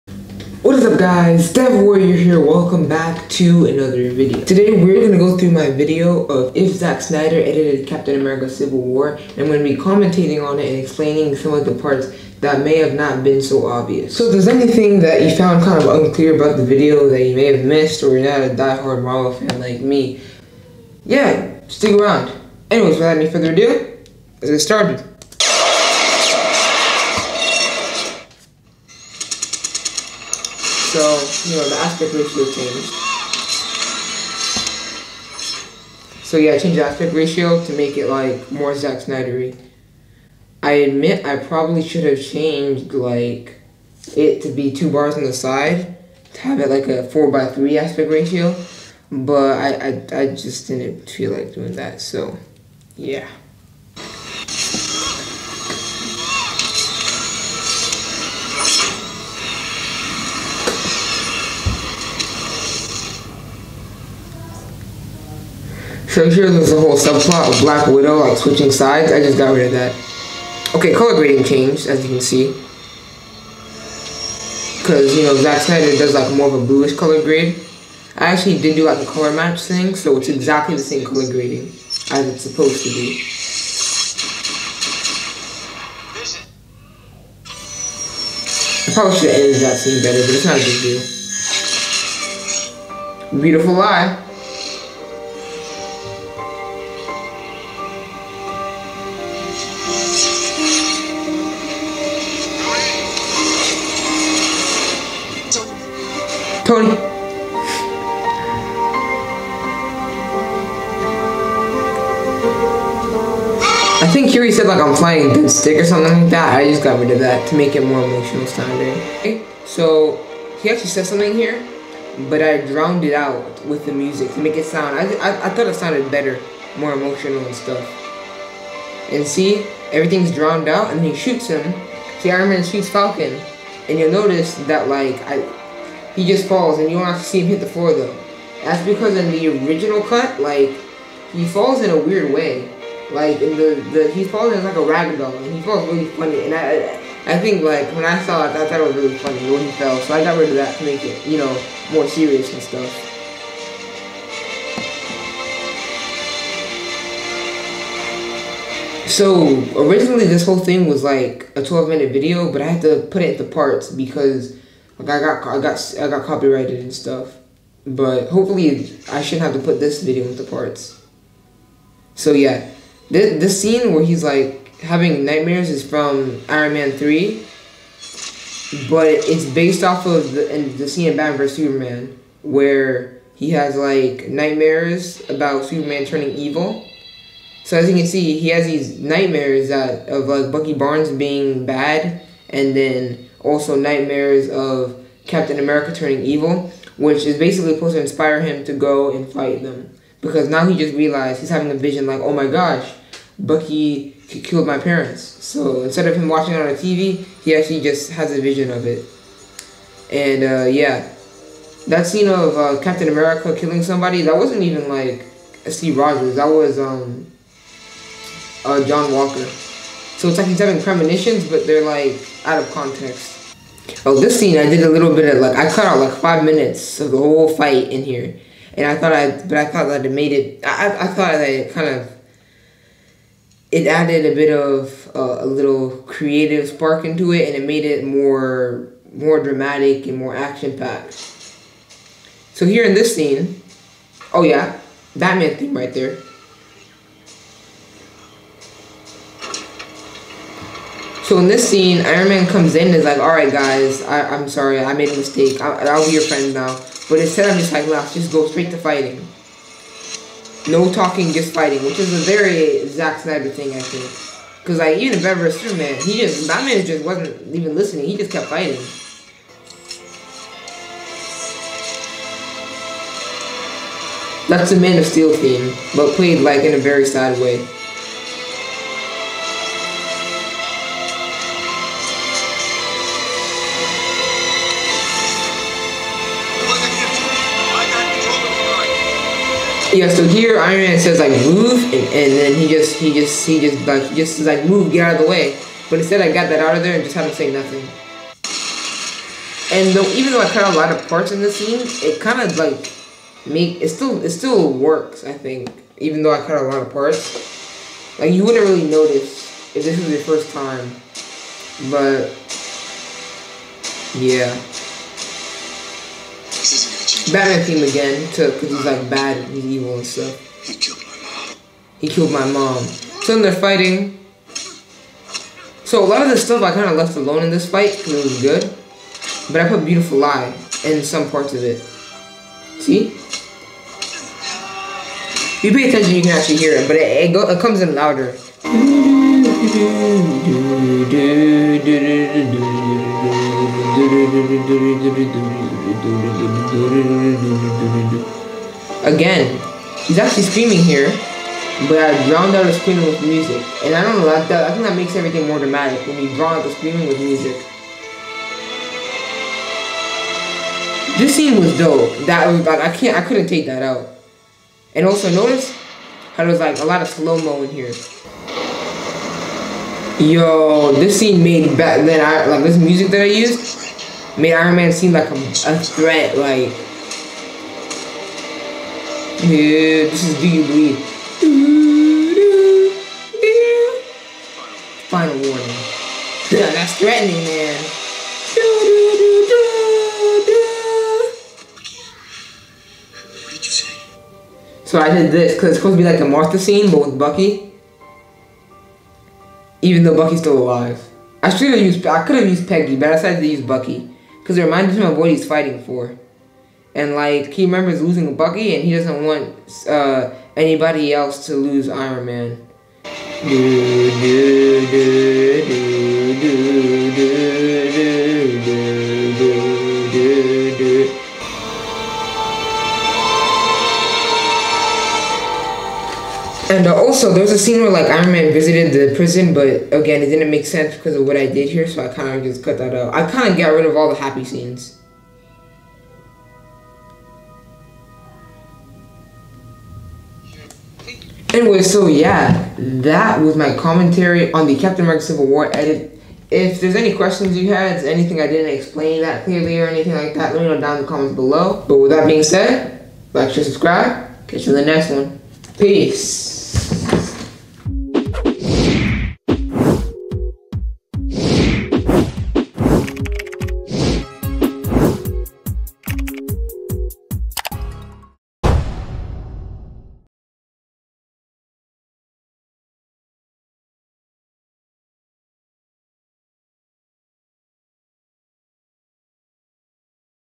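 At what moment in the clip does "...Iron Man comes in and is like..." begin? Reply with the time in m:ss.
4:12.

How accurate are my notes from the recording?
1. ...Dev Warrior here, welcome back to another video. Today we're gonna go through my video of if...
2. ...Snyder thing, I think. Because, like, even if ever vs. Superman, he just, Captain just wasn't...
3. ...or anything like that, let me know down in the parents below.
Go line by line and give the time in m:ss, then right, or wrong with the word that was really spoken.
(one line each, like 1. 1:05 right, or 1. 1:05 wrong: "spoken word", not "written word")
1. 0:01 right
2. 4:23 wrong: "Batman", not "Captain"
3. 7:29 wrong: "comments", not "parents".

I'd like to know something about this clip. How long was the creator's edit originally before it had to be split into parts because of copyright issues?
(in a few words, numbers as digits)
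12 minutes.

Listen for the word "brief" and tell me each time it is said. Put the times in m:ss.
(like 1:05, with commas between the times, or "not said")
not said.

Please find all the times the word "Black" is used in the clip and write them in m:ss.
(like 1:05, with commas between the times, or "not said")
1:07.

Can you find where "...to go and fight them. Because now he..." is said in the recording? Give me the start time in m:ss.
3:18.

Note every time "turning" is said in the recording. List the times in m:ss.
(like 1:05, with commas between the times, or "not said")
3:06, 3:15.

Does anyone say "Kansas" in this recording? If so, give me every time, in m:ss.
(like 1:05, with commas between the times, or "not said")
not said.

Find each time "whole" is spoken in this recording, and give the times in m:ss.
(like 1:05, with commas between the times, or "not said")
1:06, 2:40, 3:47.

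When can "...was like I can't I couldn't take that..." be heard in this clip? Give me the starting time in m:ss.
6:02.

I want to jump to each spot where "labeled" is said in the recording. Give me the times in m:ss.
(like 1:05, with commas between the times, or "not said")
not said.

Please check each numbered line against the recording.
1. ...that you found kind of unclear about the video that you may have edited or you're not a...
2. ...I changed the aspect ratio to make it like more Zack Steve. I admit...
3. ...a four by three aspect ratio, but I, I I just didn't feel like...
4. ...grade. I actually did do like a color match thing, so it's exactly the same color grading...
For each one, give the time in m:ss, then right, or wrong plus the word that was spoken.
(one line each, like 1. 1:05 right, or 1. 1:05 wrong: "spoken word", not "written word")
1. 0:15 wrong: "missed", not "edited"
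2. 0:36 wrong: "Snydery", not "Steve"
3. 0:46 right
4. 1:17 right.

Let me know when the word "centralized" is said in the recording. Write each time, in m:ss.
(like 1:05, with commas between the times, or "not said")
not said.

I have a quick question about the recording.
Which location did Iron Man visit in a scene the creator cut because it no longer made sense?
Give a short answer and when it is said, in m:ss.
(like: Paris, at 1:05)
the prison, at 7:09.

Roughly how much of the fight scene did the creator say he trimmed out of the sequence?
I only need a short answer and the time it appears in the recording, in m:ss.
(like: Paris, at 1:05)
5 minutes, at 3:46.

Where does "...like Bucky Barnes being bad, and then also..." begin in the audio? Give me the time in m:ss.
3:10.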